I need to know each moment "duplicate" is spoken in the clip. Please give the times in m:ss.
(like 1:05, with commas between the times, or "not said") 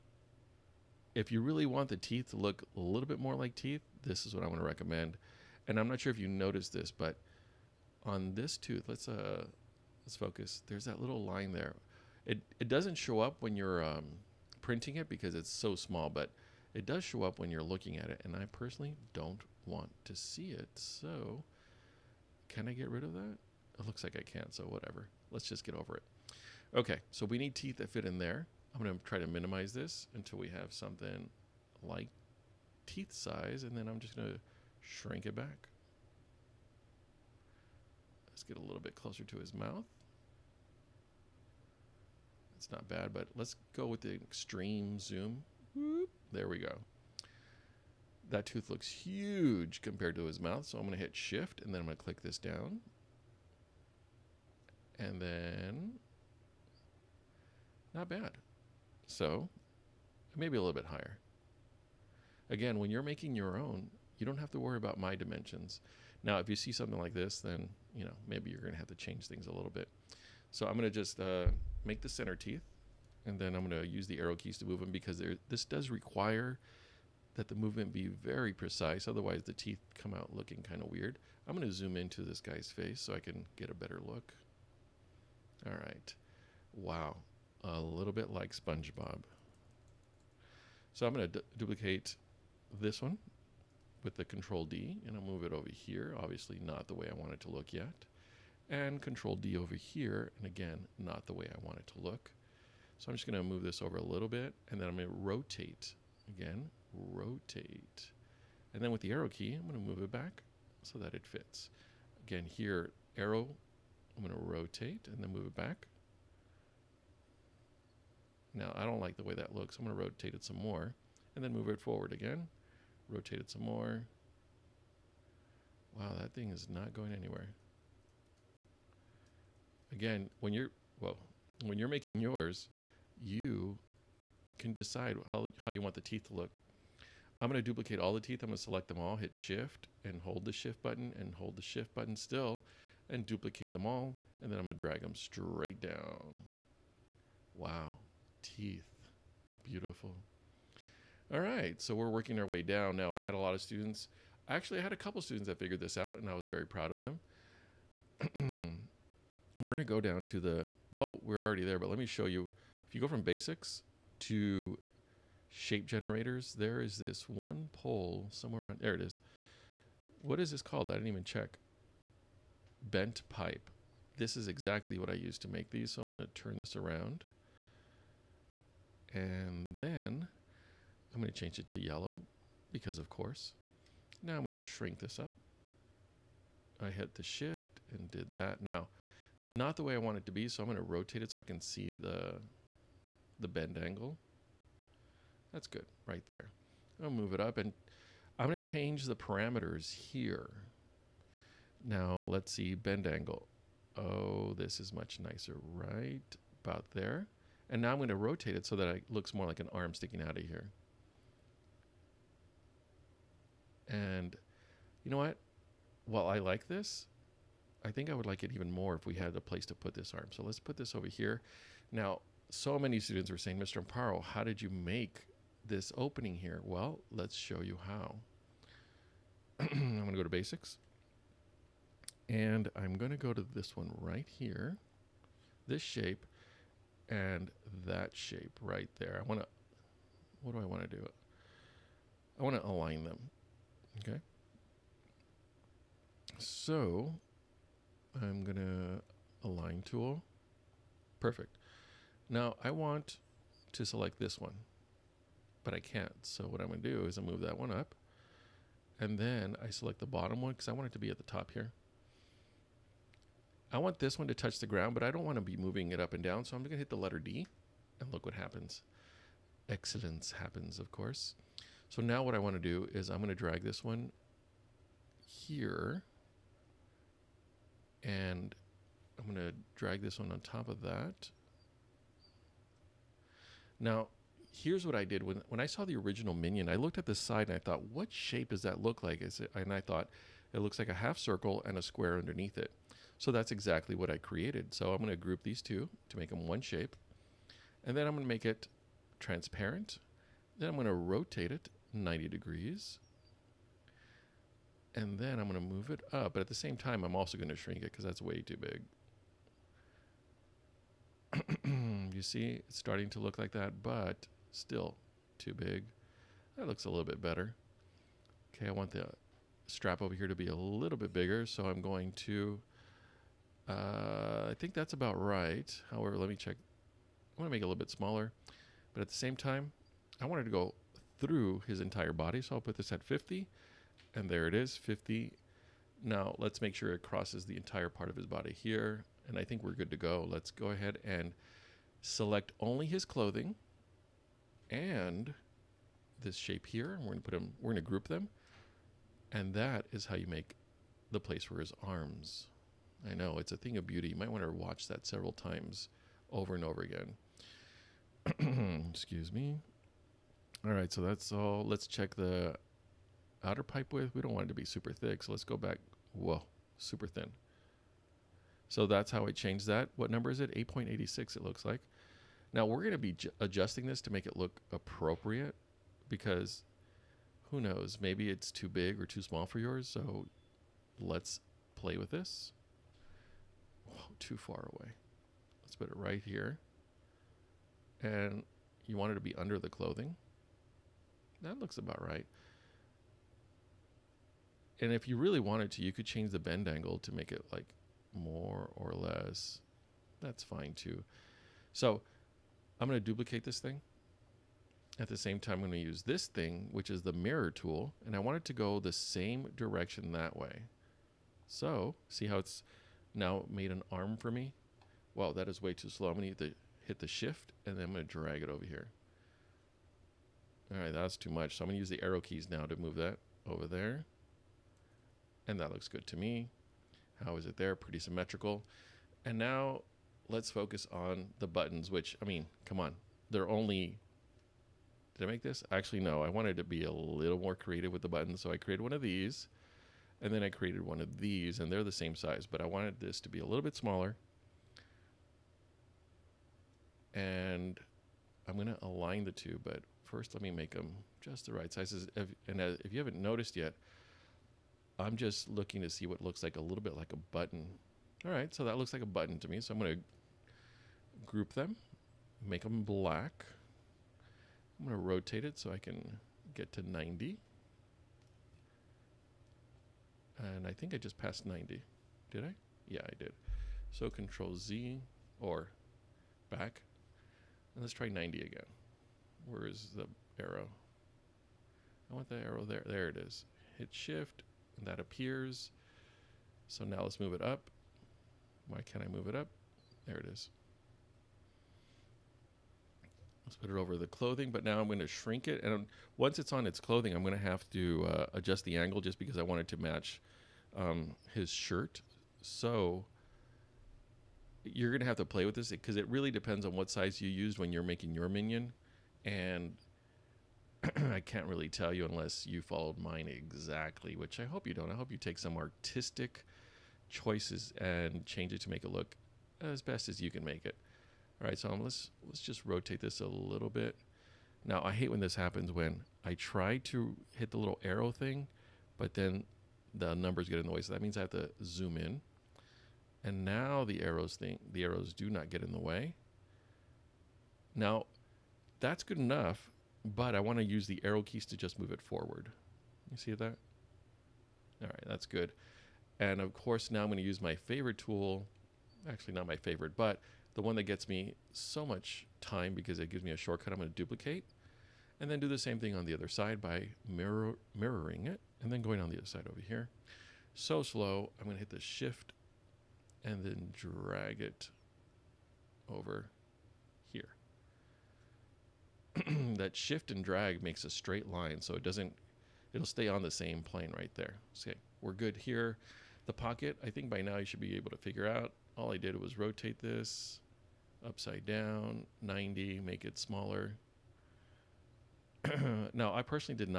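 1:31, 2:17, 2:23, 6:43, 9:13.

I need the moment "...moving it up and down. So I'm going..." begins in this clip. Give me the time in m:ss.
4:25.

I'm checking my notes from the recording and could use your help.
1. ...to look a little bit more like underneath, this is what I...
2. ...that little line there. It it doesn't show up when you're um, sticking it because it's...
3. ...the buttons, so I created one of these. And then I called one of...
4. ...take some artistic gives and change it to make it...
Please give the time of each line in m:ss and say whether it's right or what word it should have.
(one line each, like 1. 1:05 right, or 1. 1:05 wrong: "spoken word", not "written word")
1. 0:02 wrong: "teeth", not "underneath"
2. 0:10 wrong: "printing", not "sticking"
3. 7:18 wrong: "created", not "called"
4. 8:35 wrong: "choices", not "gives".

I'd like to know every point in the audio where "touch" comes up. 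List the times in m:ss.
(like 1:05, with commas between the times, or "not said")
4:24.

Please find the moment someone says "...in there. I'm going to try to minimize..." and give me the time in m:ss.
0:28.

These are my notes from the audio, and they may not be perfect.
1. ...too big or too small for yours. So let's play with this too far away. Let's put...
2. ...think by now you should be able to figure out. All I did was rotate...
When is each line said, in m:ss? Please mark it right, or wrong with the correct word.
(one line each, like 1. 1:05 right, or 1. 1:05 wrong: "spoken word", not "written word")
1. 6:18 right
2. 9:36 right.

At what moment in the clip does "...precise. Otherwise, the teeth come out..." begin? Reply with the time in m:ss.
1:18.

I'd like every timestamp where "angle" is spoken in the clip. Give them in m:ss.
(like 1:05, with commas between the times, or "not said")
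3:13, 3:23, 6:36, 8:18.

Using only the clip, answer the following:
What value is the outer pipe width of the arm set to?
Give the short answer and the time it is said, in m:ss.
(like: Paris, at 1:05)
8.86, at 6:10.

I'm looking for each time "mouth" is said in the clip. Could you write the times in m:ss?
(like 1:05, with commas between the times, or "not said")
0:39, 0:50.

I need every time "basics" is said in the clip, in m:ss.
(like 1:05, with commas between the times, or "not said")
2:43, 3:50.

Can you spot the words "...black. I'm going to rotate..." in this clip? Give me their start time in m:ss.
7:42.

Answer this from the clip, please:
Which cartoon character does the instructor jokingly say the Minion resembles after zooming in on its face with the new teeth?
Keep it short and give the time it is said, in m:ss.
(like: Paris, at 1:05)
SpongeBob, at 1:28.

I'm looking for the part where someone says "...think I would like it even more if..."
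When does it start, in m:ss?
3:37.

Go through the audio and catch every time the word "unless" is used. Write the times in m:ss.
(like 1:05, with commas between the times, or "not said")
8:32.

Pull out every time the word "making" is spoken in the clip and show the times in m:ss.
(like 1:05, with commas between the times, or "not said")
1:03, 2:11, 8:27.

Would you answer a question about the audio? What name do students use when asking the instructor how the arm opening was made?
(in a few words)
Mr. Amparo.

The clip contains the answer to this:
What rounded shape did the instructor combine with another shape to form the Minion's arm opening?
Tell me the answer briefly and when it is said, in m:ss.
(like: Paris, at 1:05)
Half circle, at 4:50.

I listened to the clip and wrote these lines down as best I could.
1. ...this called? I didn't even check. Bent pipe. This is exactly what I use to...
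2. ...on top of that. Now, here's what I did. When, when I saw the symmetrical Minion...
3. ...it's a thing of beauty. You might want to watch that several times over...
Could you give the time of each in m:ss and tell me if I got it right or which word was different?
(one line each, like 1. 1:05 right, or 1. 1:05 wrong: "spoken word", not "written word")
1. 2:50 right
2. 4:40 wrong: "original", not "symmetrical"
3. 5:53 right.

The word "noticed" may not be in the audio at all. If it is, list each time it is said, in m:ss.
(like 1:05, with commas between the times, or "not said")
0:06, 7:33.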